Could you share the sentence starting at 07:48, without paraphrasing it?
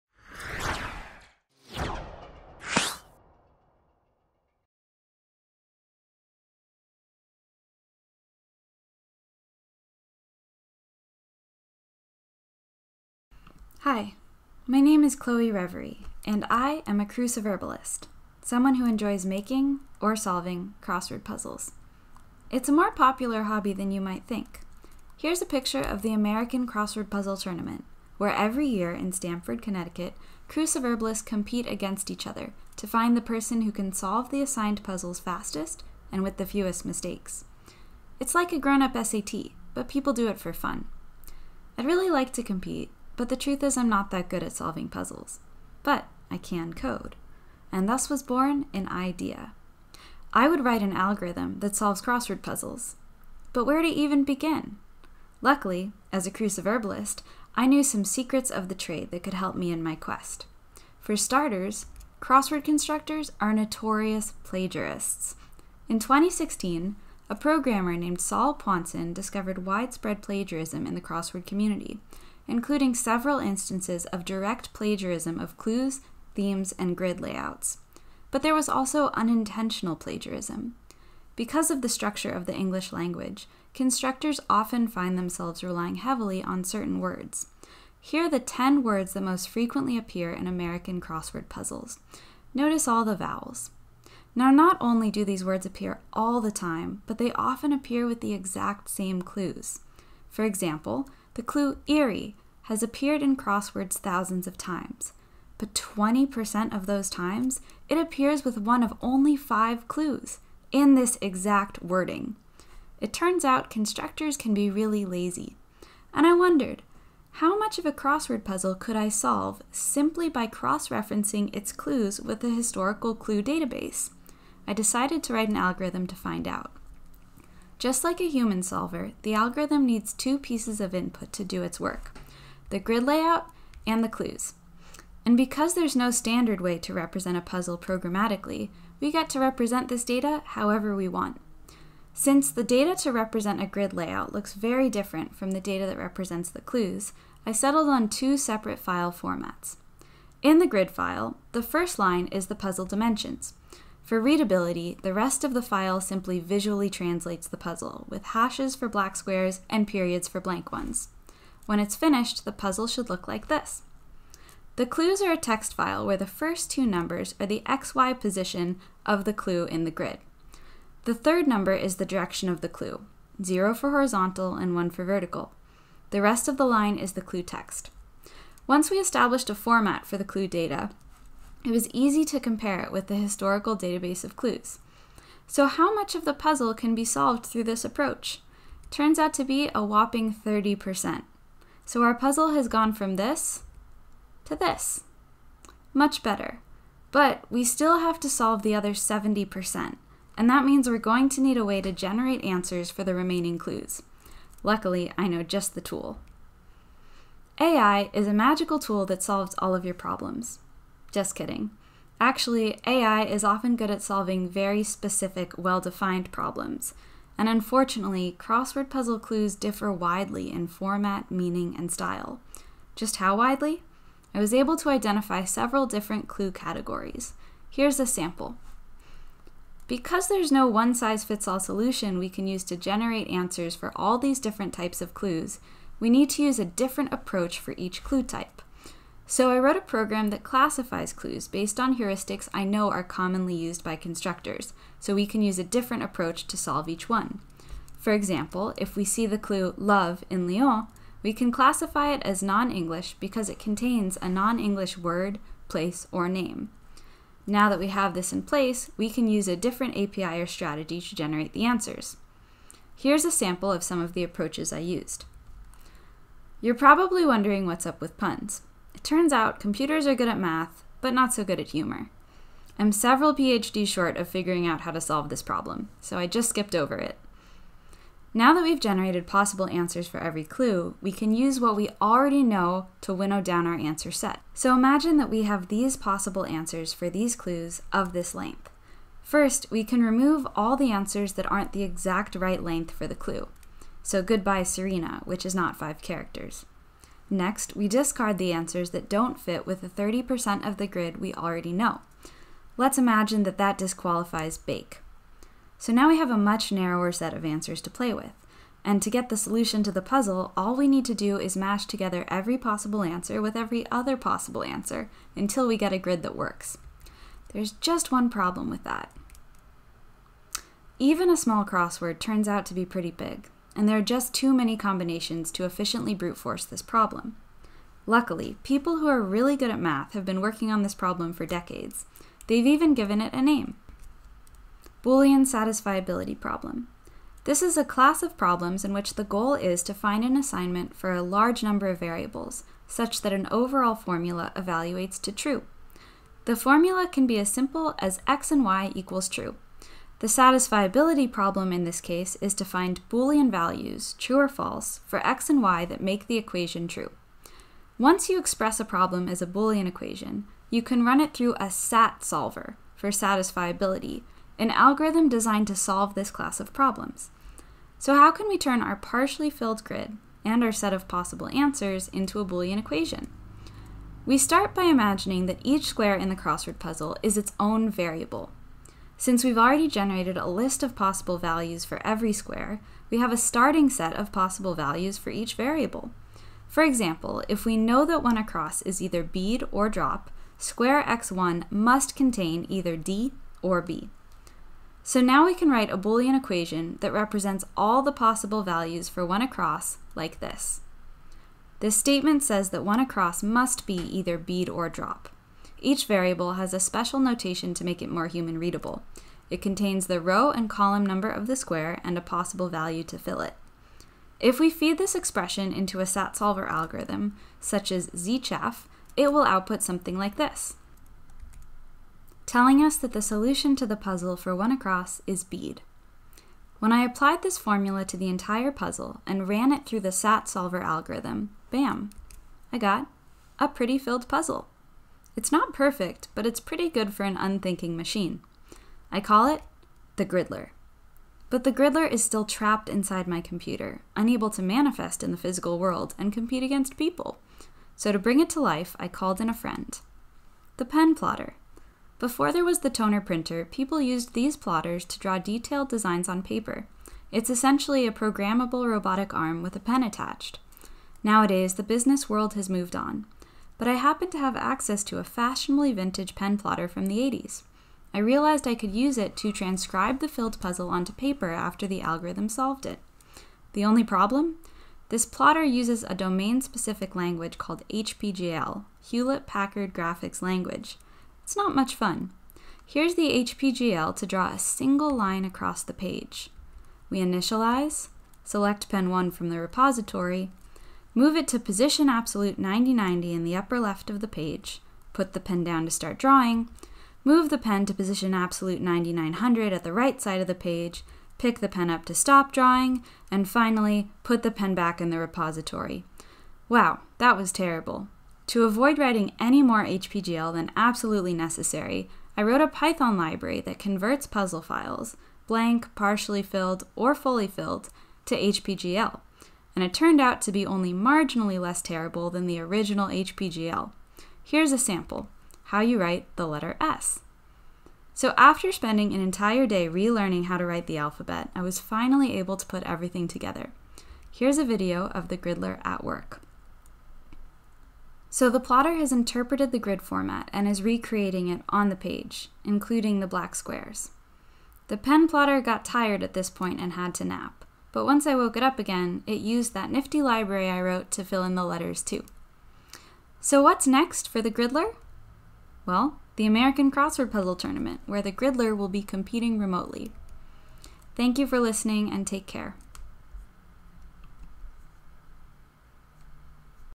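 I realized I could use it to transcribe the filled puzzle onto paper after the algorithm solved it.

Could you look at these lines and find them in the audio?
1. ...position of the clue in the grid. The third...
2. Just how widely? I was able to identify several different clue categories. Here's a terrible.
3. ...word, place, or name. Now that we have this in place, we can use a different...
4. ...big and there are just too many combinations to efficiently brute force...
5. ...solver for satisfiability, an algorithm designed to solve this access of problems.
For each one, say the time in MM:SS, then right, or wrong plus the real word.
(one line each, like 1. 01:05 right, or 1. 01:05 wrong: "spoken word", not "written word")
1. 02:48 right
2. 03:42 wrong: "sample", not "terrible"
3. 04:14 right
4. 05:23 right
5. 06:02 wrong: "class", not "access".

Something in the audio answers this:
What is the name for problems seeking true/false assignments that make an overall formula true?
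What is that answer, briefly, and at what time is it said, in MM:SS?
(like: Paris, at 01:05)
Boolean satisfiability problem, at 05:35.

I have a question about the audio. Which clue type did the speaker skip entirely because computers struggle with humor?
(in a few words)
Puns.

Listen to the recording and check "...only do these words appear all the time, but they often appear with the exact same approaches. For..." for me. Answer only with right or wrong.
wrong.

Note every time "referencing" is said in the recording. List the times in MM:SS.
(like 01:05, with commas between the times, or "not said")
02:00.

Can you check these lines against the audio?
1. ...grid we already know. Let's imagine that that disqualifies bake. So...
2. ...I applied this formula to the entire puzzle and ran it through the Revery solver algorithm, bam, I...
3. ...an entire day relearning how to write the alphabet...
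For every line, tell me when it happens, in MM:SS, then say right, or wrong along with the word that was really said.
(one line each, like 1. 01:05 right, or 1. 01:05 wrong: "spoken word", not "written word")
1. 05:00 right
2. 07:06 wrong: "SAT", not "Revery"
3. 08:49 right.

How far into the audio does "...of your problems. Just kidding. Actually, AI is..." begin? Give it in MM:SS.
03:29.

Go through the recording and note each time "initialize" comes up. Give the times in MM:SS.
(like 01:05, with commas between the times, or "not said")
08:07.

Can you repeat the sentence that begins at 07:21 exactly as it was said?
But the Gridler is still trapped inside my computer, unable to manifest in the physical world and compete against people.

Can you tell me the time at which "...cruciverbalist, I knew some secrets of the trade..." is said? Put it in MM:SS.
00:56.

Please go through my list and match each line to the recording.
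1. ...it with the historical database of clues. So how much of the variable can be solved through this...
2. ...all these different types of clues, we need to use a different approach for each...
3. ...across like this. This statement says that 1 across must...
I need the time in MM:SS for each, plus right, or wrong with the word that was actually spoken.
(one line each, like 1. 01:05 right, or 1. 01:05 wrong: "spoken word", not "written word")
1. 03:02 wrong: "puzzle", not "variable"
2. 03:53 right
3. 06:39 right.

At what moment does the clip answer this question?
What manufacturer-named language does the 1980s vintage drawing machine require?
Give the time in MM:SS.
07:59.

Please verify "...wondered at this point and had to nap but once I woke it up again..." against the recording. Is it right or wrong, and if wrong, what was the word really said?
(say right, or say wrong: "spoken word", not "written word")
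wrong: "tired", not "wondered".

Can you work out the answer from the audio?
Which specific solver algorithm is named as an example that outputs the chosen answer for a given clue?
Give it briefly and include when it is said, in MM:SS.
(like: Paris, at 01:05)
zChaff, at 06:58.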